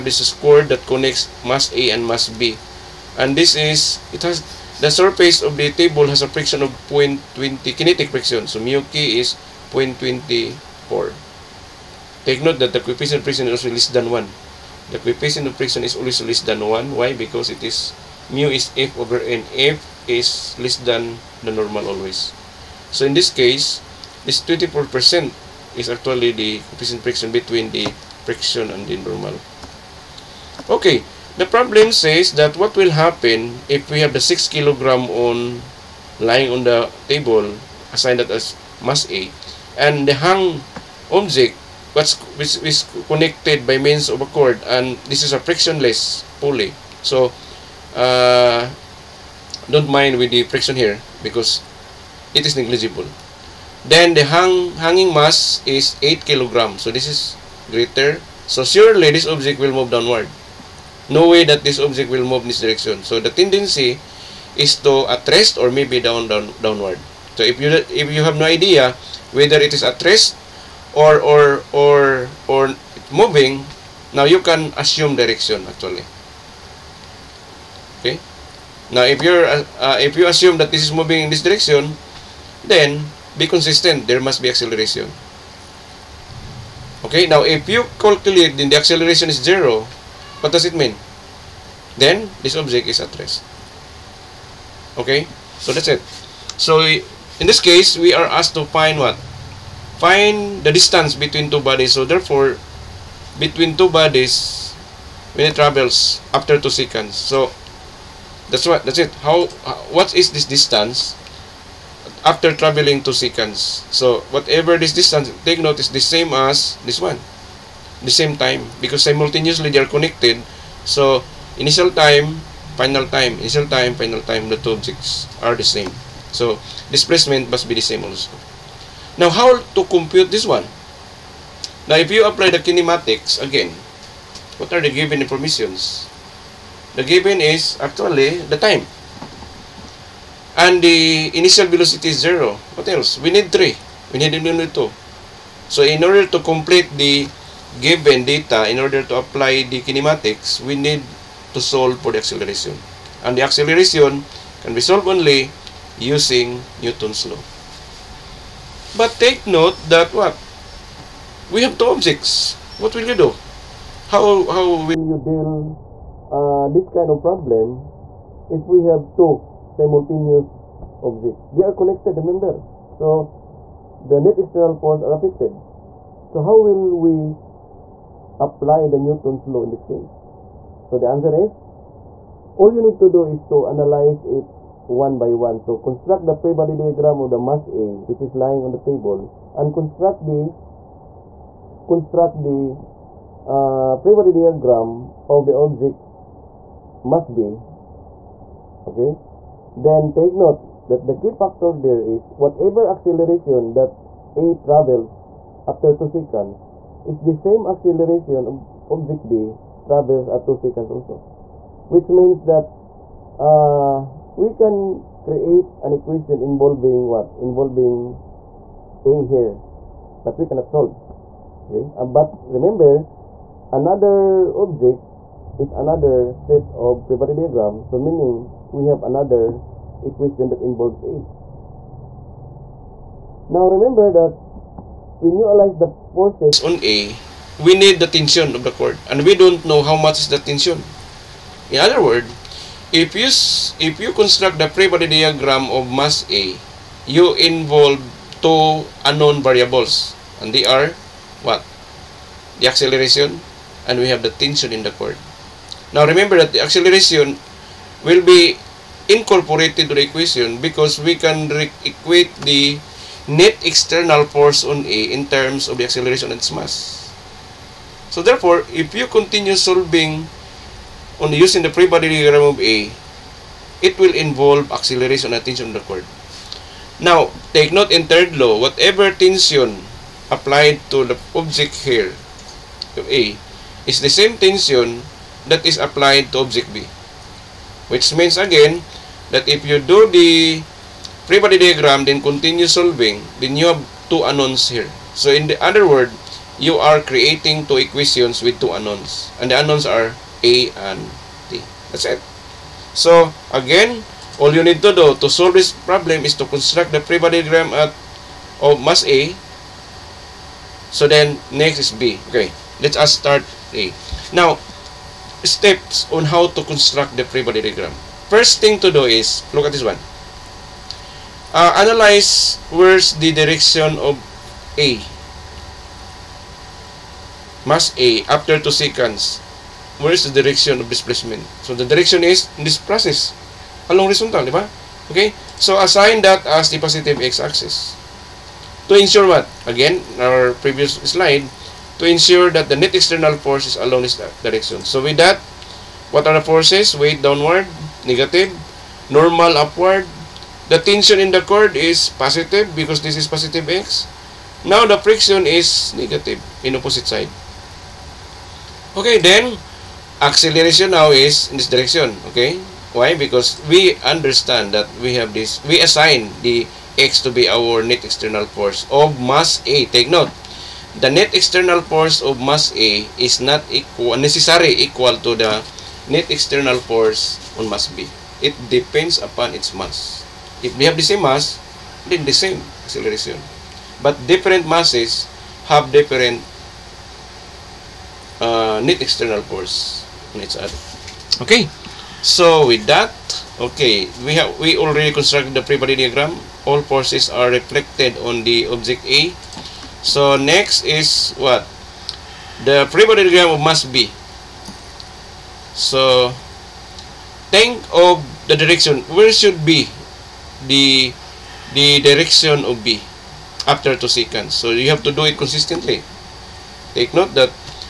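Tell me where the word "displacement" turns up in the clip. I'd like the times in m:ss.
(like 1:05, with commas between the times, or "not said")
2:06, 5:30.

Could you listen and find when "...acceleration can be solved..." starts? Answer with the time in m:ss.
2:33.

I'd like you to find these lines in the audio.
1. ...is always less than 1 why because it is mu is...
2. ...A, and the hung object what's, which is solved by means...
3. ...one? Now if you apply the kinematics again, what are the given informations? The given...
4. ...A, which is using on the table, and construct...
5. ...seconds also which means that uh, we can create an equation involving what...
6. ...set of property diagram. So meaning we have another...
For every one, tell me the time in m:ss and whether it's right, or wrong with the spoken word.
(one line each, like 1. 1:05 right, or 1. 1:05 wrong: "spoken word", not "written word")
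1. 0:15 right
2. 0:39 wrong: "connected", not "solved"
3. 2:10 right
4. 3:07 wrong: "lying", not "using"
5. 3:30 right
6. 3:46 right.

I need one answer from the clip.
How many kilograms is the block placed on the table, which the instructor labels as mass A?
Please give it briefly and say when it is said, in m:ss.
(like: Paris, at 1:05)
6 kilograms, at 0:34.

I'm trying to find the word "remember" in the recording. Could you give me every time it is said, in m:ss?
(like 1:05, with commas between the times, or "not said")
2:52, 3:42, 3:53, 4:16.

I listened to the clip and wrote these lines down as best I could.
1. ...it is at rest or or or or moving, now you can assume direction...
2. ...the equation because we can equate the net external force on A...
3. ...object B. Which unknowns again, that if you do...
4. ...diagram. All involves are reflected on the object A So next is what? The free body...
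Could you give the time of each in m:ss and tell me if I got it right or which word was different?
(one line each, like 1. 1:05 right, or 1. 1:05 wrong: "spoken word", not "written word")
1. 1:09 right
2. 4:19 right
3. 4:46 wrong: "means", not "unknowns"
4. 6:35 wrong: "forces", not "involves".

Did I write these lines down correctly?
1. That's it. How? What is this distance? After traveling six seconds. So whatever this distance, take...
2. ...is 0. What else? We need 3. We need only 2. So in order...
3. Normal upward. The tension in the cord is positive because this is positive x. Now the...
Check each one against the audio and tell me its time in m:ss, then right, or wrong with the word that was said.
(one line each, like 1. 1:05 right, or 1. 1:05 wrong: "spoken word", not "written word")
1. 1:48 wrong: "two", not "six"
2. 2:22 right
3. 5:49 right.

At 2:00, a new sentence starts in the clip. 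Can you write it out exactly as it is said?
So initial time, final time, initial time, final time.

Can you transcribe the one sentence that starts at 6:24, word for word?
But different masses have different uh, net external force on each other.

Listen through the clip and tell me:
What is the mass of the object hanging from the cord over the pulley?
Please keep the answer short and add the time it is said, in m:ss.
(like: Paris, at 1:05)
8 kilograms, at 0:56.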